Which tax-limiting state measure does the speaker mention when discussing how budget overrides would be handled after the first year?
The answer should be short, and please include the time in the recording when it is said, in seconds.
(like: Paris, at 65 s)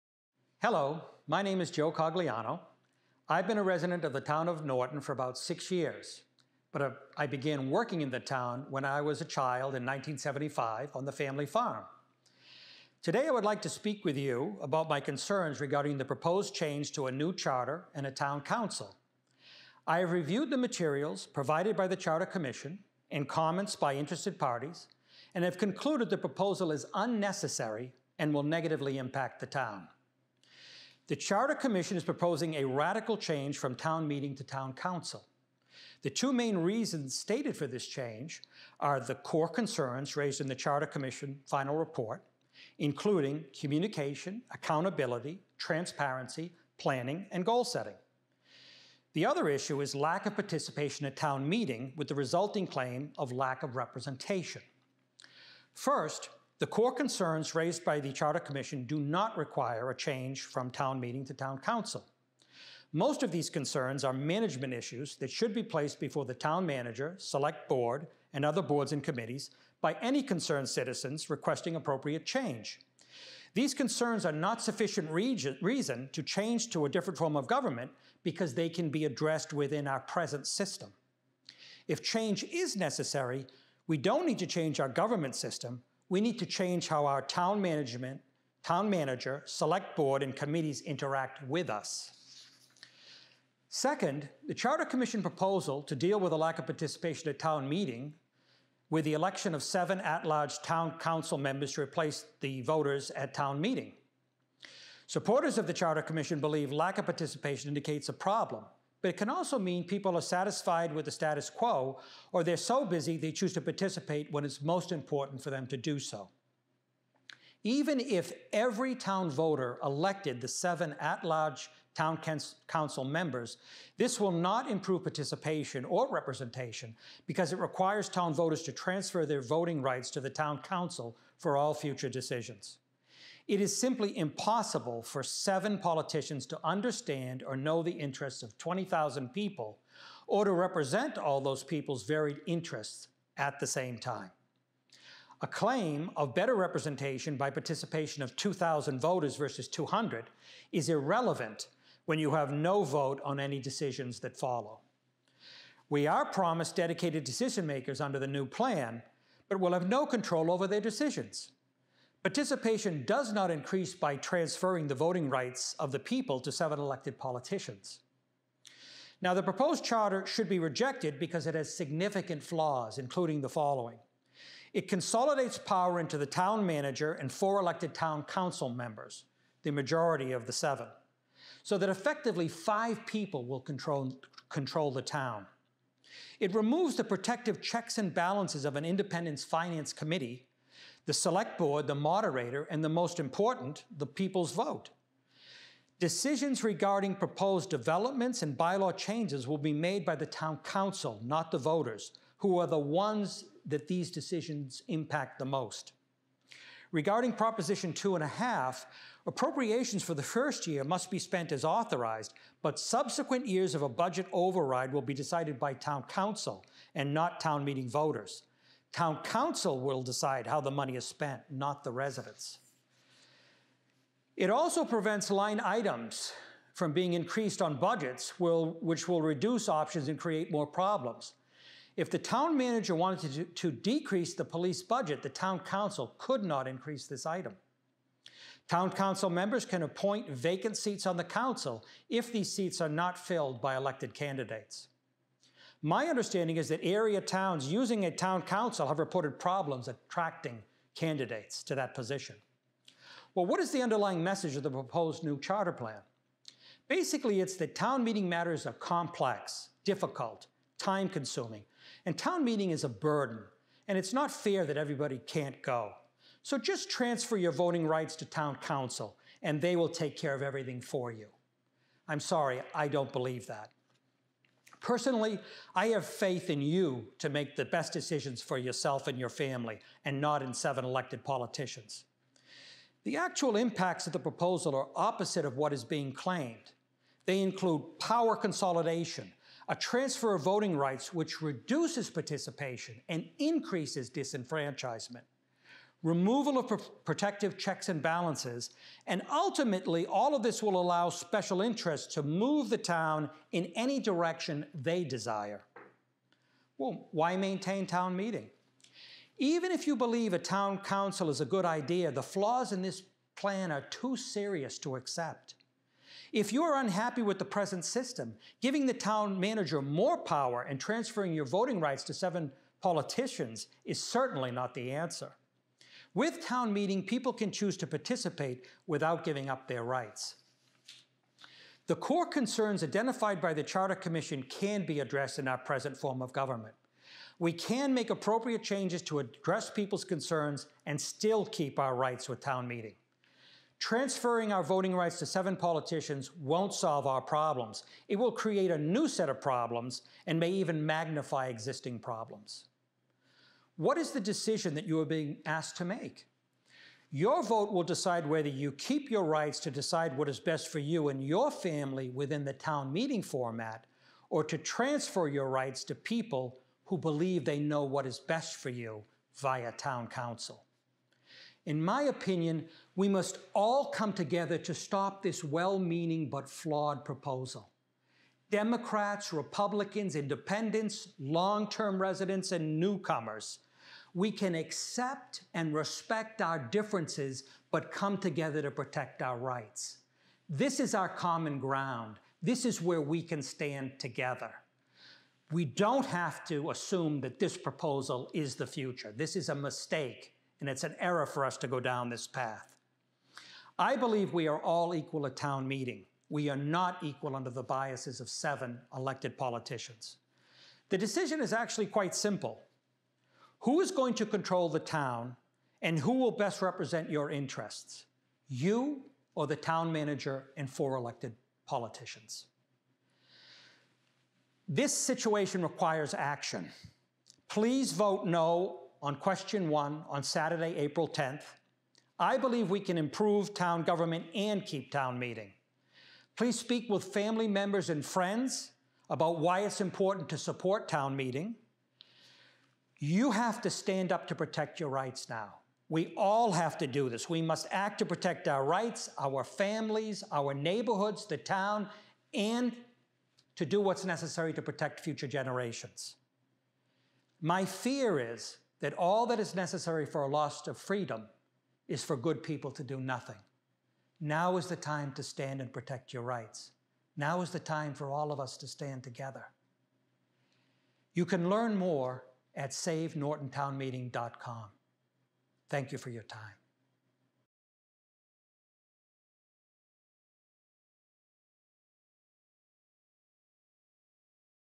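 Proposition Two and a Half, at 207 s.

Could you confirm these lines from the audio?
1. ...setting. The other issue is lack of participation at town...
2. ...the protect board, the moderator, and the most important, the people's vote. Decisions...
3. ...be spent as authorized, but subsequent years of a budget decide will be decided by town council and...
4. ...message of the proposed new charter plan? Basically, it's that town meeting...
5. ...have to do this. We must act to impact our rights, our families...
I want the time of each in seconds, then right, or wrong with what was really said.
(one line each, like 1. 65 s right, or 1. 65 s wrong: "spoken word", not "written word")
1. 47 s right
2. 191 s wrong: "select", not "protect"
3. 211 s wrong: "override", not "decide"
4. 254 s right
5. 446 s wrong: "protect", not "impact".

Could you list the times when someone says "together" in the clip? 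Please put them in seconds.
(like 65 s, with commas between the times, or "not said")
374 s, 388 s, 393 s, 469 s.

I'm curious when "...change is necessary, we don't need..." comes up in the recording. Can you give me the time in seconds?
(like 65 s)
82 s.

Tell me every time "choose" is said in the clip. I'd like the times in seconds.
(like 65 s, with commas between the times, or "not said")
113 s, 327 s.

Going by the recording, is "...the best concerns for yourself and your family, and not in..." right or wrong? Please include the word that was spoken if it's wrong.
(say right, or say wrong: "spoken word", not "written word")
wrong: "decisions", not "concerns".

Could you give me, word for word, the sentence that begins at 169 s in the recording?
Now, the proposed charter should be rejected because it has significant flaws, including the following.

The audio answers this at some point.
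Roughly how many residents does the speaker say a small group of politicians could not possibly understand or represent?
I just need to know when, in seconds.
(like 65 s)
138 s.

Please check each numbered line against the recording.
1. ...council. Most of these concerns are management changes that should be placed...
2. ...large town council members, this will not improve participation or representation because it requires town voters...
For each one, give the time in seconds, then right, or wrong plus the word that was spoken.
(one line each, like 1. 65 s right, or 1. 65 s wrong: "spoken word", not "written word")
1. 61 s wrong: "issues", not "changes"
2. 121 s right.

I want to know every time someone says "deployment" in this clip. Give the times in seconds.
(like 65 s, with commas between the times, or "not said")
not said.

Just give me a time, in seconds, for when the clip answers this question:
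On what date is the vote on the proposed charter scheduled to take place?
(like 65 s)
430 s.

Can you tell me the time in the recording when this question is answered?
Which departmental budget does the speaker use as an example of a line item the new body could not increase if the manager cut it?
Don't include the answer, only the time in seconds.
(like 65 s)
234 s.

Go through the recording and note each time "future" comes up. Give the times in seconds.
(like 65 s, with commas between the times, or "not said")
131 s, 398 s, 454 s.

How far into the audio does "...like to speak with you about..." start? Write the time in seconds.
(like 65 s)
13 s.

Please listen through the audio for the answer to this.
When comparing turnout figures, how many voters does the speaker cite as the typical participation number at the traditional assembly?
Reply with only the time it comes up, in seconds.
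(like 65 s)
149 s.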